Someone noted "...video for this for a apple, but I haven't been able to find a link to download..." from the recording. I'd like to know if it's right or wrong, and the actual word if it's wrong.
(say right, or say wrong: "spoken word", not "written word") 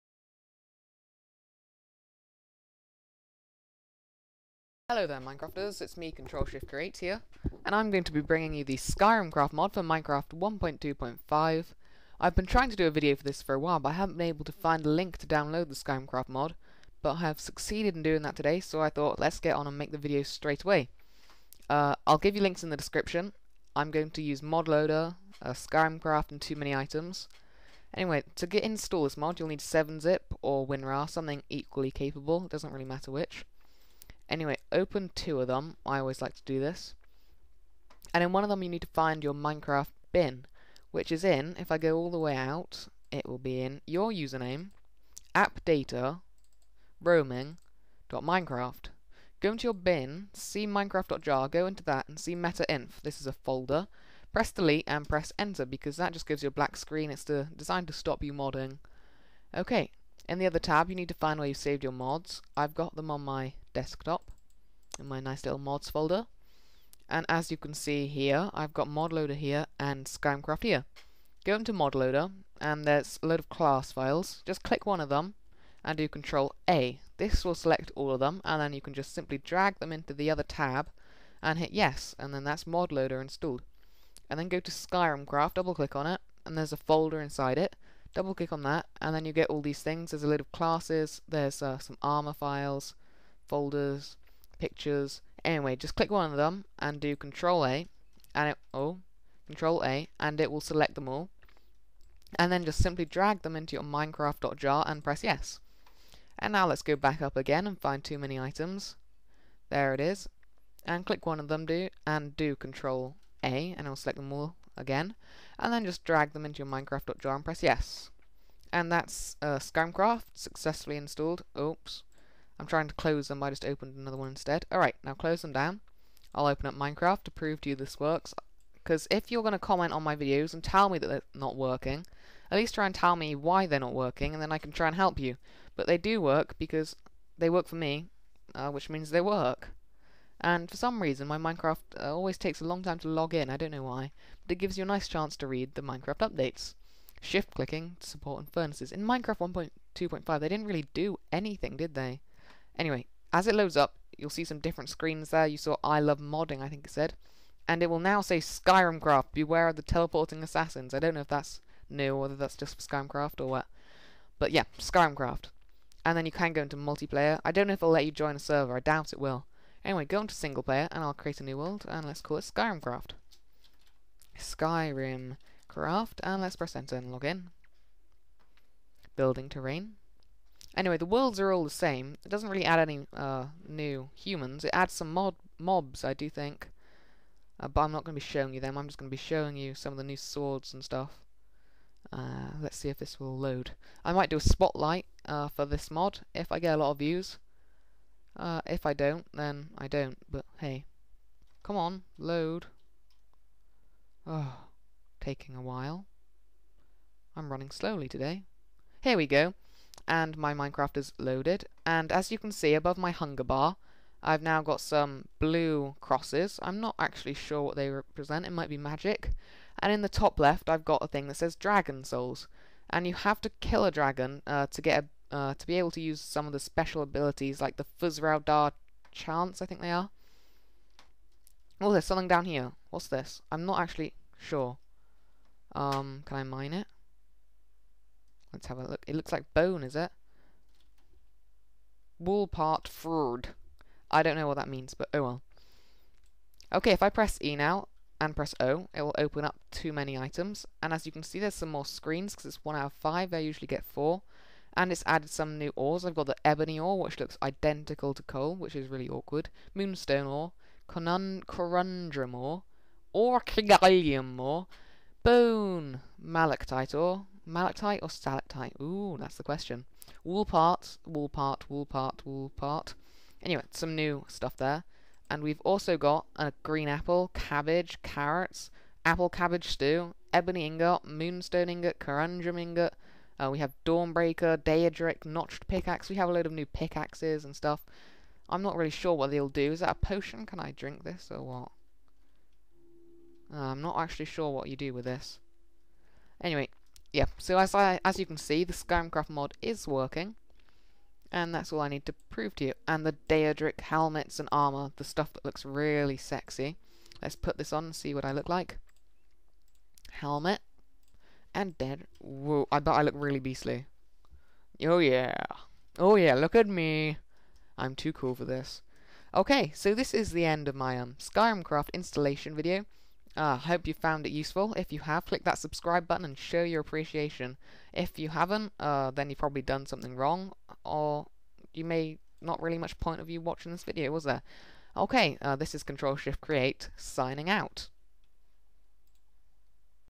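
wrong: "while", not "apple".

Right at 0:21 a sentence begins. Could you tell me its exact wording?
Uh, I'll give you links in the description.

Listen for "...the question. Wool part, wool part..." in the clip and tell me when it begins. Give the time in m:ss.
4:29.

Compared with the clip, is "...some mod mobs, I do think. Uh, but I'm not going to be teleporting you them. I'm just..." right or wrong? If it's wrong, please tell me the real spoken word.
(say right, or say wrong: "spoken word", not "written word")
wrong: "showing", not "teleporting".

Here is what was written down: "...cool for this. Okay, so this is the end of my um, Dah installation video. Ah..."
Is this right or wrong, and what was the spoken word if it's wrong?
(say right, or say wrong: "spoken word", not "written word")
wrong: "Skyrimcraft", not "Dah".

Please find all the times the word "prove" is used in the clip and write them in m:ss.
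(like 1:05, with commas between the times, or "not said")
2:07, 5:02.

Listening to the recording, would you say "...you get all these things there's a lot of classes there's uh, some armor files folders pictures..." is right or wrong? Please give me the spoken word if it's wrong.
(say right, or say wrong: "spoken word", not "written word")
right.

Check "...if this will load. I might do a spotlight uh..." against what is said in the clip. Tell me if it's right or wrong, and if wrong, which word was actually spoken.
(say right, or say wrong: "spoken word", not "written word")
right.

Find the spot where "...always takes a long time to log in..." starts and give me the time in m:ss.
2:22.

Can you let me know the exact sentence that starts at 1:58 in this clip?
And that's uh, Skyrimcraft successfully installed.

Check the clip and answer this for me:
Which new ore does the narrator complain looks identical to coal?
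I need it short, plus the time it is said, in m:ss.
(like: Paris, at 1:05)
Ebony ore, at 4:16.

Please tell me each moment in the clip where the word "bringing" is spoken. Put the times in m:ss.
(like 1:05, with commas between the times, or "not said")
0:08.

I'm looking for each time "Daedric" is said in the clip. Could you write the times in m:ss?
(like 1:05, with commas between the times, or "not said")
4:44, 5:03.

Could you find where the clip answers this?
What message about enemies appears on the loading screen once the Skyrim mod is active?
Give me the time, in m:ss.
2:39.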